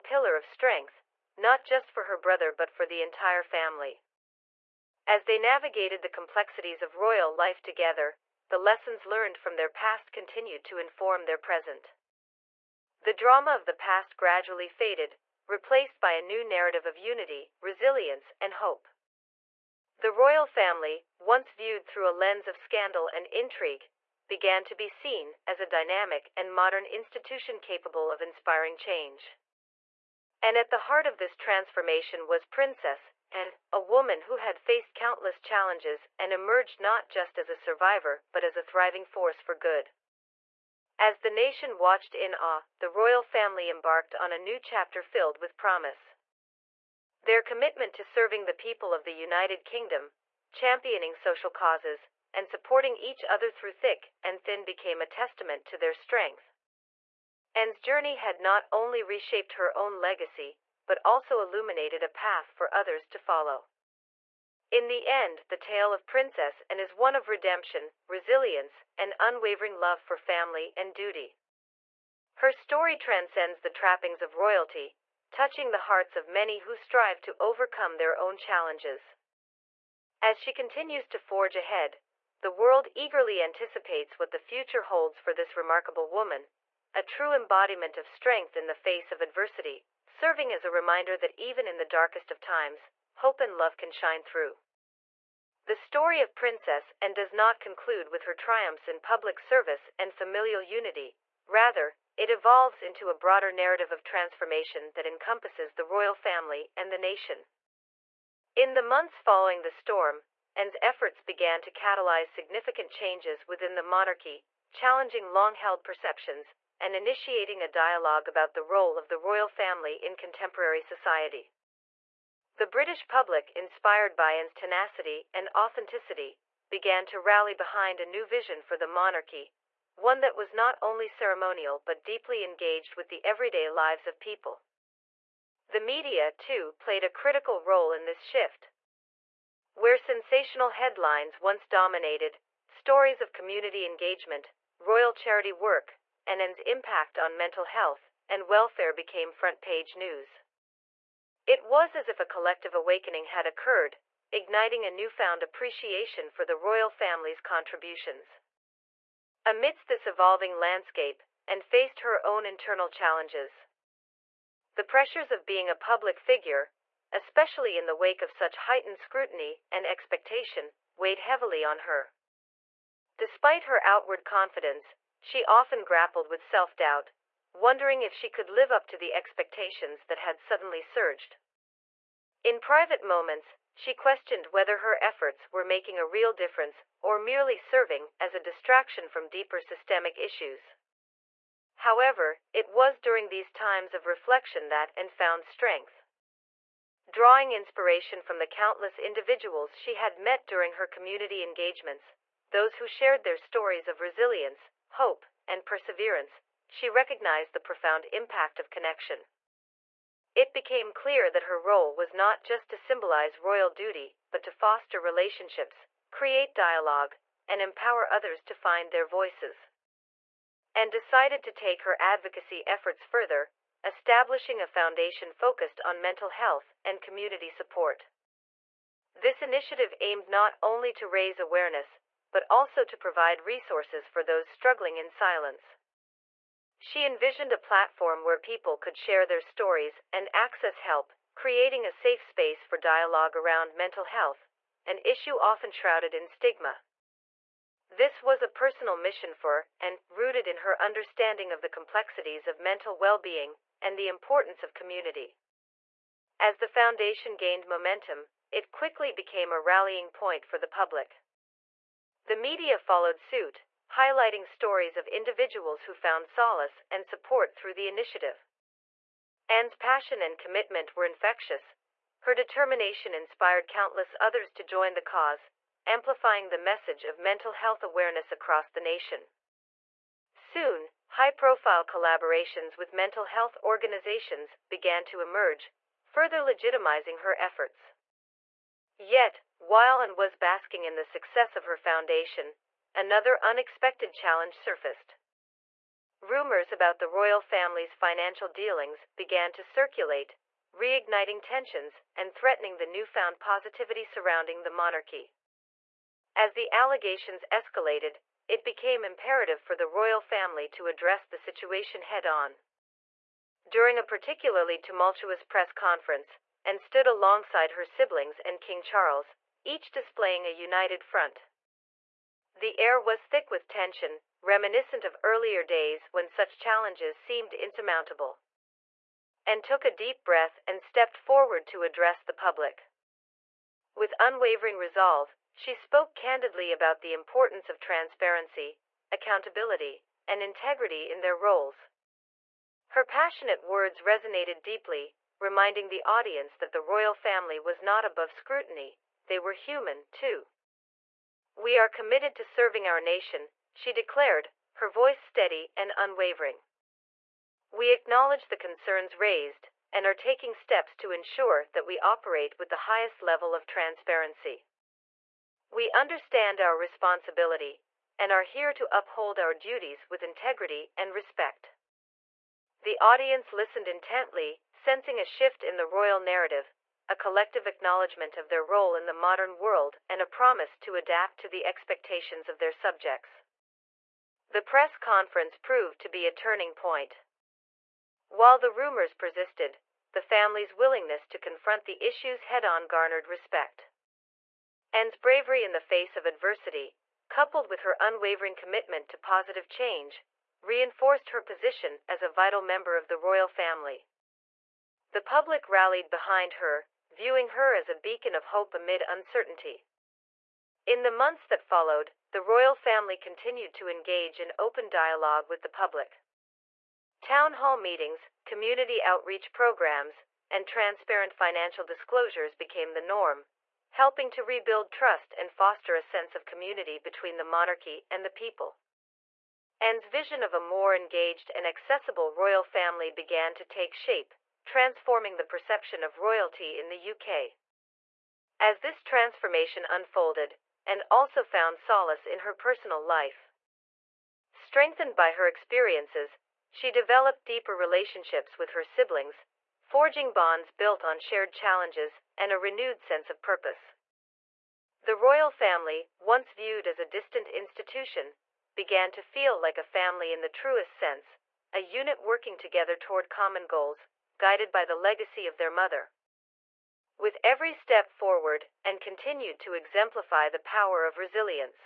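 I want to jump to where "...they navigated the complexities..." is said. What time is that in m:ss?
0:05.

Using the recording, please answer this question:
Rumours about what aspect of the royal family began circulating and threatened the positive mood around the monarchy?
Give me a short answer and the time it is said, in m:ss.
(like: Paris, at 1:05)
Financial dealings, at 4:57.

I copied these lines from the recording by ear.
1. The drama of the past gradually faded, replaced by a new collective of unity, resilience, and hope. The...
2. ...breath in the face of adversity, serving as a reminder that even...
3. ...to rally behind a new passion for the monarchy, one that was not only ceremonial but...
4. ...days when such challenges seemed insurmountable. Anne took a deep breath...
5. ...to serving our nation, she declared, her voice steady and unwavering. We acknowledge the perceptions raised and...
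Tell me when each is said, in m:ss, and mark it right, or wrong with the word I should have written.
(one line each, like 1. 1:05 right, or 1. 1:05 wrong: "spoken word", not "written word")
1. 0:12 wrong: "narrative", not "collective"
2. 1:28 wrong: "strength", not "breath"
3. 2:07 wrong: "vision", not "passion"
4. 5:25 right
5. 5:52 wrong: "concerns", not "perceptions".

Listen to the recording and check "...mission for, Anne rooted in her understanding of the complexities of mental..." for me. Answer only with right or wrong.
right.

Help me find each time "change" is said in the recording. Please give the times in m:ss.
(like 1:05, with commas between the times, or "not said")
0:28, 1:52, 6:39.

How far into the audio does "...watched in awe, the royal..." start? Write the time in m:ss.
0:41.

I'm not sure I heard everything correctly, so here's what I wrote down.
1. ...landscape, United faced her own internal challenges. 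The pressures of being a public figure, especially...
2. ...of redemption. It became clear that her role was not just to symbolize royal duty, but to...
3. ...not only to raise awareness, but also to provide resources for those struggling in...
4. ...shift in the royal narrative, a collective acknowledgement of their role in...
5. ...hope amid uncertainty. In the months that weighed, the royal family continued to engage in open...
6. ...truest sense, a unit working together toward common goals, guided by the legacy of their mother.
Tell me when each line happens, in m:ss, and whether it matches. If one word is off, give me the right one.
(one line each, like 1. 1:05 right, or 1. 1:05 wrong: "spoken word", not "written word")
1. 2:40 wrong: "Anne", not "United"
2. 3:28 wrong: "connection", not "redemption"
3. 3:50 right
4. 6:15 right
5. 6:48 wrong: "followed", not "weighed"
6. 7:40 right.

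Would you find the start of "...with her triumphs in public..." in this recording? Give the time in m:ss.
1:38.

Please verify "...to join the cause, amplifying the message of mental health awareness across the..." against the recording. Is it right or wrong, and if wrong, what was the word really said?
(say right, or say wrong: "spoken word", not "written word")
right.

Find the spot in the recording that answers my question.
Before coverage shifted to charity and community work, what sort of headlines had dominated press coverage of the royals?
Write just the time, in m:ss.
2:19.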